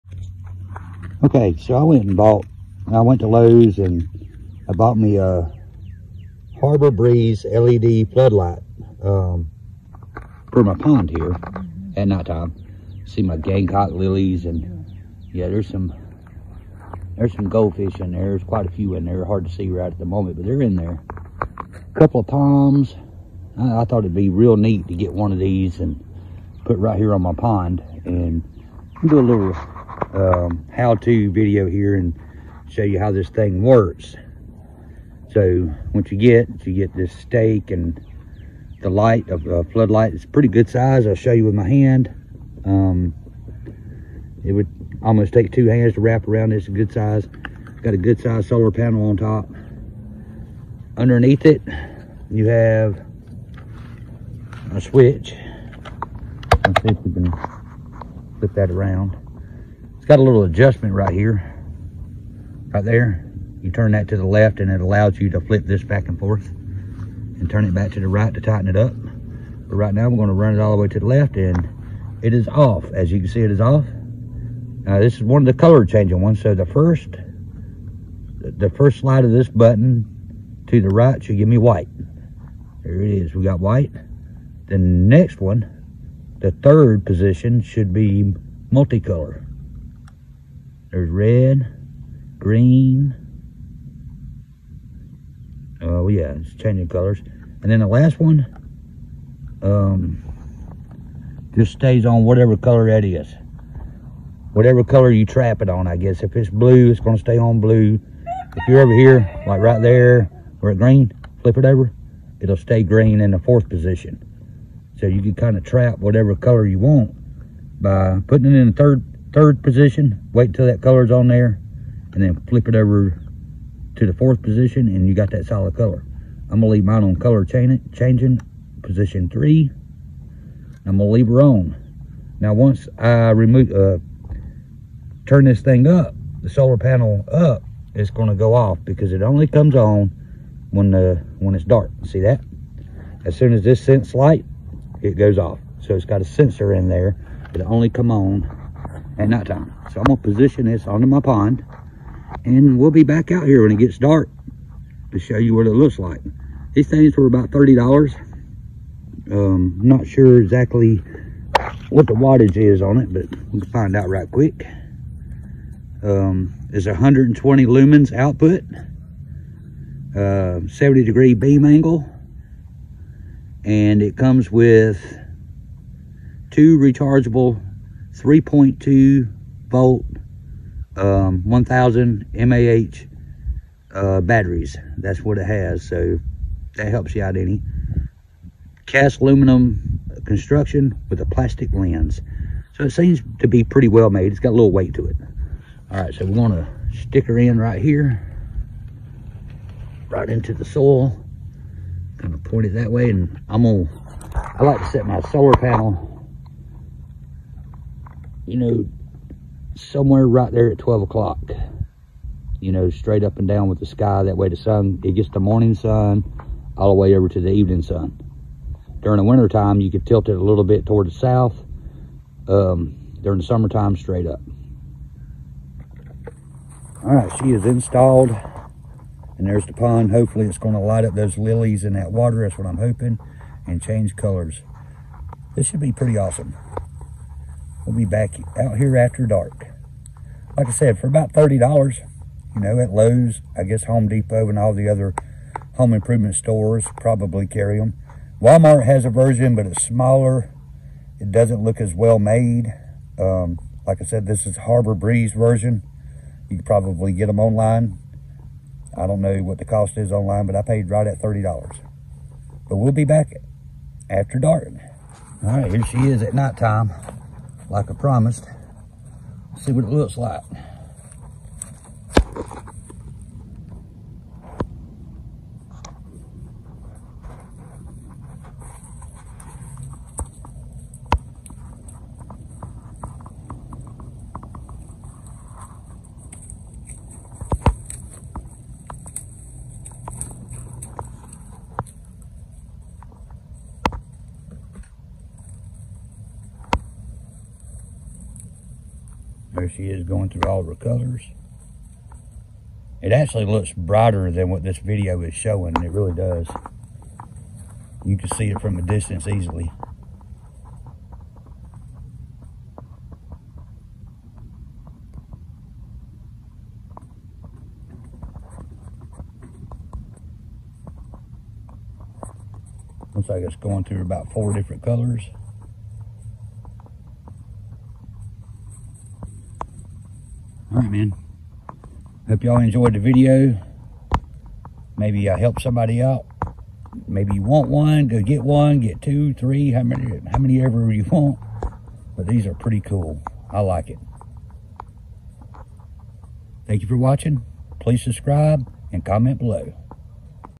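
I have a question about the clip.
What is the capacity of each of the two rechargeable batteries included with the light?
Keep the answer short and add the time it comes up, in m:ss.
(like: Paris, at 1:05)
1000 mAh, at 3:01.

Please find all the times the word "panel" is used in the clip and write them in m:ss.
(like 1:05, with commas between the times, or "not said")
0:48, 2:16, 3:25.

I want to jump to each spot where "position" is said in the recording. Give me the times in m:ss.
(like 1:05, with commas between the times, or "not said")
1:27, 1:53, 1:59, 2:04, 2:08, 2:30.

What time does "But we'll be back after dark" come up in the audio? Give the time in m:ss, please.
4:22.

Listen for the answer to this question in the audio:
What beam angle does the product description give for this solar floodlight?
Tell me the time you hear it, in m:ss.
2:50.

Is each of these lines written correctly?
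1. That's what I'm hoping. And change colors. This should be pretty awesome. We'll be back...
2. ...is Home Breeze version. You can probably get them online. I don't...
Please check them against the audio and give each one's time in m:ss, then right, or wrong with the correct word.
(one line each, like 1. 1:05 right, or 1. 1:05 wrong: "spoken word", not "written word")
1. 3:52 right
2. 4:14 wrong: "Harbor", not "Home".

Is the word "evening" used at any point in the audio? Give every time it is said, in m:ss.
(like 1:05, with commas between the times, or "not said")
3:37.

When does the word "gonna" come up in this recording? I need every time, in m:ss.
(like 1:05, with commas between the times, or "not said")
1:10, 1:46, 2:06, 2:10, 2:18, 2:30, 3:16, 3:23.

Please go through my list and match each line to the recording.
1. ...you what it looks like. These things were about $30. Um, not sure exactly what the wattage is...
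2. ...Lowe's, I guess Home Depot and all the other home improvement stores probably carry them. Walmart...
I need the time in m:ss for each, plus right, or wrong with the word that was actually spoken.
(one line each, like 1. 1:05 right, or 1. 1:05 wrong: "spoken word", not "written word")
1. 2:35 right
2. 4:02 right.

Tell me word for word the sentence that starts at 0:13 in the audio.
See my Gamecock lilies and yeah, there's some, there's some goldfish in there.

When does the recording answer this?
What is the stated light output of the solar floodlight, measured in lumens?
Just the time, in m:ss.
2:46.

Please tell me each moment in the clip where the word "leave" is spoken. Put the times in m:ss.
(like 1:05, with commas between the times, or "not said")
2:06, 2:11.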